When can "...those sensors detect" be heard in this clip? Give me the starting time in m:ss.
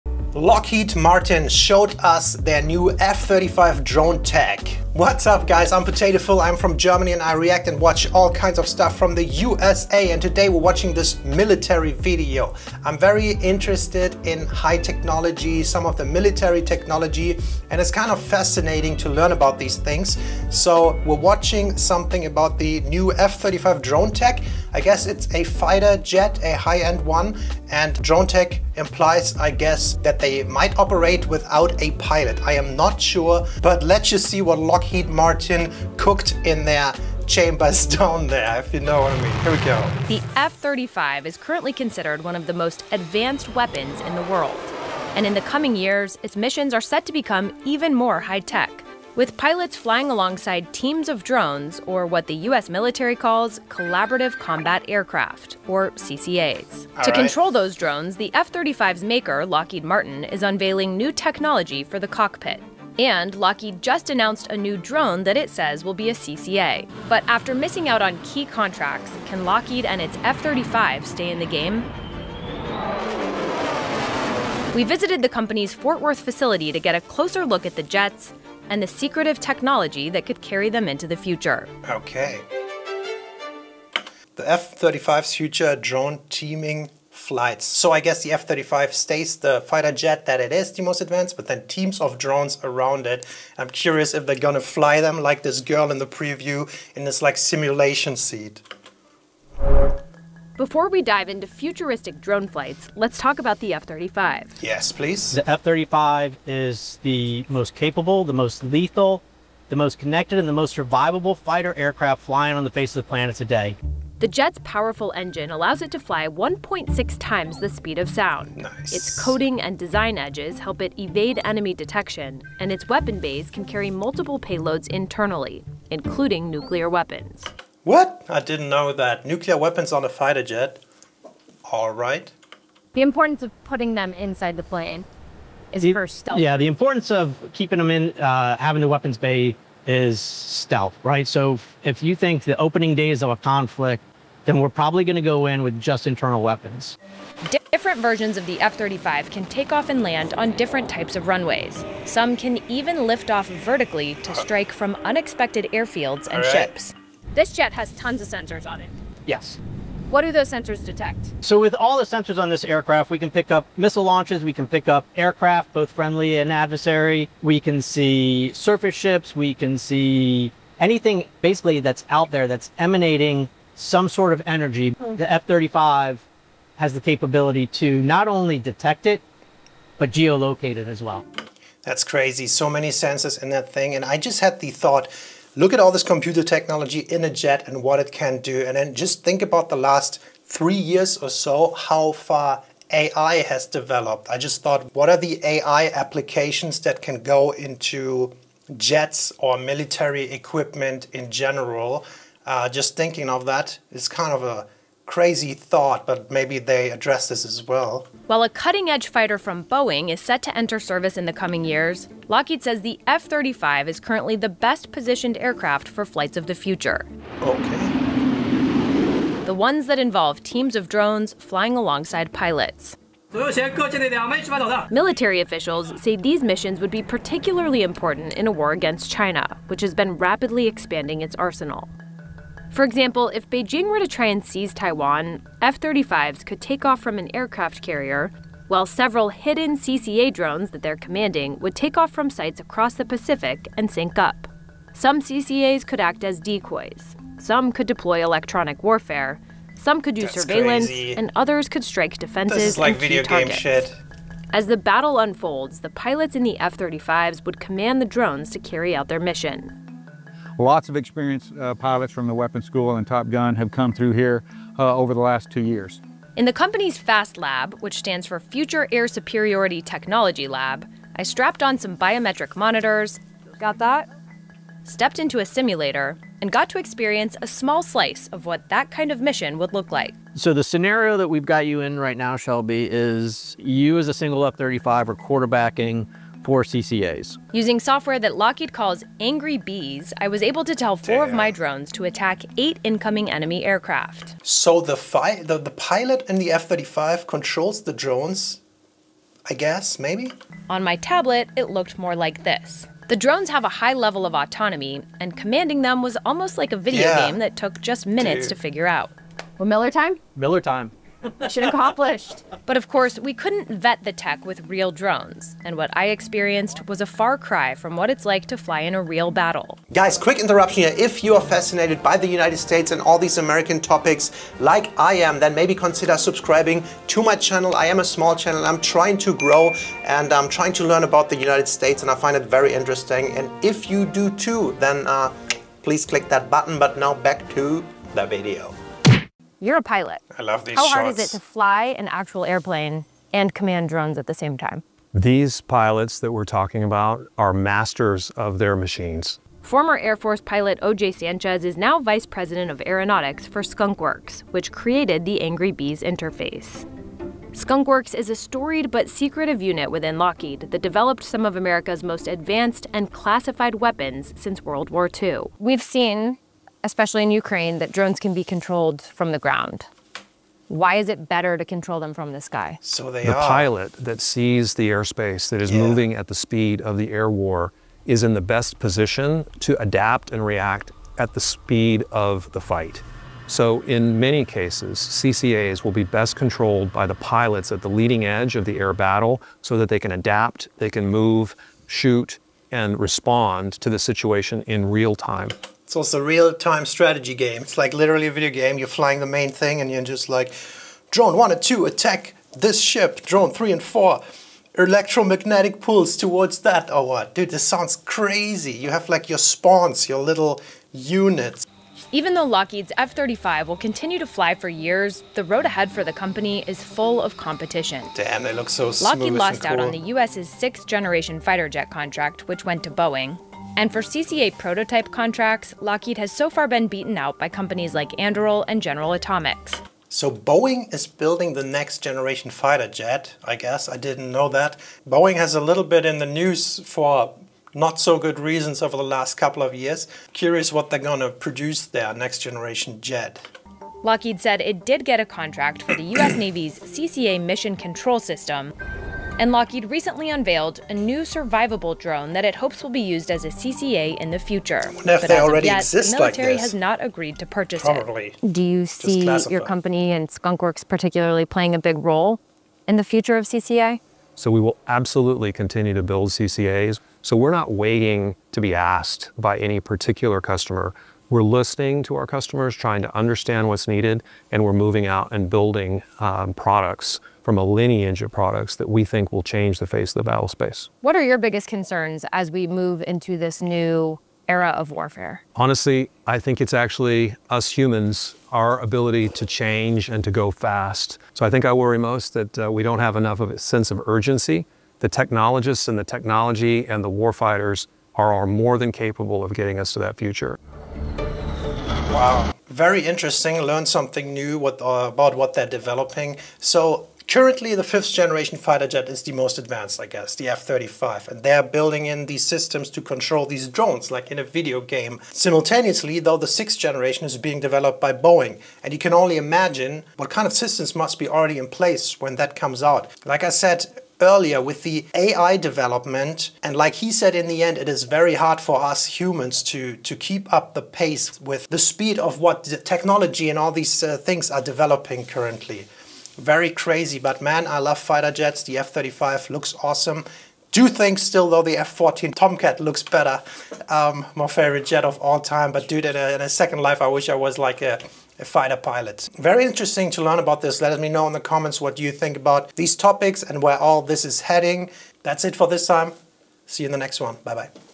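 2:40.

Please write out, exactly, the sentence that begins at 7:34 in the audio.
I wonder if but they already yet, exist The military like has not agreed to purchase Probably.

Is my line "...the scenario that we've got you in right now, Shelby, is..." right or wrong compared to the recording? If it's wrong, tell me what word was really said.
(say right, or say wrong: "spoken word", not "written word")
right.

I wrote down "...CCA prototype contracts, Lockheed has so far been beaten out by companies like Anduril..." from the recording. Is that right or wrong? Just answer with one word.
right.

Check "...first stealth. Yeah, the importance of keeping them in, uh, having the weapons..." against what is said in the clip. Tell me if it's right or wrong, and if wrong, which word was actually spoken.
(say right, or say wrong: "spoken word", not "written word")
right.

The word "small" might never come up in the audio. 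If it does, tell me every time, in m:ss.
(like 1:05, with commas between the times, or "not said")
4:37, 5:28.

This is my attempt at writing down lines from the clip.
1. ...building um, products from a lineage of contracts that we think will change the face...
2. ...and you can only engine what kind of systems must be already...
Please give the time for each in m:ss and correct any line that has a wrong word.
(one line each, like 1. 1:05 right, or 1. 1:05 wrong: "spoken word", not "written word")
1. 7:55 wrong: "products", not "contracts"
2. 8:38 wrong: "imagine", not "engine".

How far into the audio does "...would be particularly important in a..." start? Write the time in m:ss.
3:46.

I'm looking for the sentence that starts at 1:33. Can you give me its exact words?
I'm curious if they're gonna fly them like this girl in the preview in this like simulation seat.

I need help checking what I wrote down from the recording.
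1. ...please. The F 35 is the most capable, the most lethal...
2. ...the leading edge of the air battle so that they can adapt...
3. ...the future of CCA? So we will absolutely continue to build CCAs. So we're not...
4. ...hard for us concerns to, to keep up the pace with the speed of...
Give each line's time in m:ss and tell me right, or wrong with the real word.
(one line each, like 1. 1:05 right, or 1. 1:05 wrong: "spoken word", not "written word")
1. 1:44 right
2. 6:27 right
3. 7:42 right
4. 8:48 wrong: "humans", not "concerns".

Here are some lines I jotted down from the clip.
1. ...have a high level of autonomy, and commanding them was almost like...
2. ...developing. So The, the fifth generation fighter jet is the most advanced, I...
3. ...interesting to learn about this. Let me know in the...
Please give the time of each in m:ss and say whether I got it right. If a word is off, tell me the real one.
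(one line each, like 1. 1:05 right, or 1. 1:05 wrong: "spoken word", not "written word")
1. 5:03 right
2. 8:25 wrong: "Currently", not "The"
3. 9:09 right.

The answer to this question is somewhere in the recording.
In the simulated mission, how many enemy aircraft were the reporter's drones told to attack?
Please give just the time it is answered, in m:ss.
4:52.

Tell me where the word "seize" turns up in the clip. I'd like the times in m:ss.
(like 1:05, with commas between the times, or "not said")
3:54.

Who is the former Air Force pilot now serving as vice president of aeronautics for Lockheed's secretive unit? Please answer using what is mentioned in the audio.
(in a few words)
O.J. Sanchez.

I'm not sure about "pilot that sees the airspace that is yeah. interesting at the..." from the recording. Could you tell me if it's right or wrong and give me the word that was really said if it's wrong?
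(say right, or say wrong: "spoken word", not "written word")
wrong: "moving", not "interesting".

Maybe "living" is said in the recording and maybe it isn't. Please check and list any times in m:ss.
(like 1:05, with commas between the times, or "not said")
not said.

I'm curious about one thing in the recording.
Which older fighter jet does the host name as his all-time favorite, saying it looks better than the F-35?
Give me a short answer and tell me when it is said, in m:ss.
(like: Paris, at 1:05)
F-14 Tomcat, at 9:01.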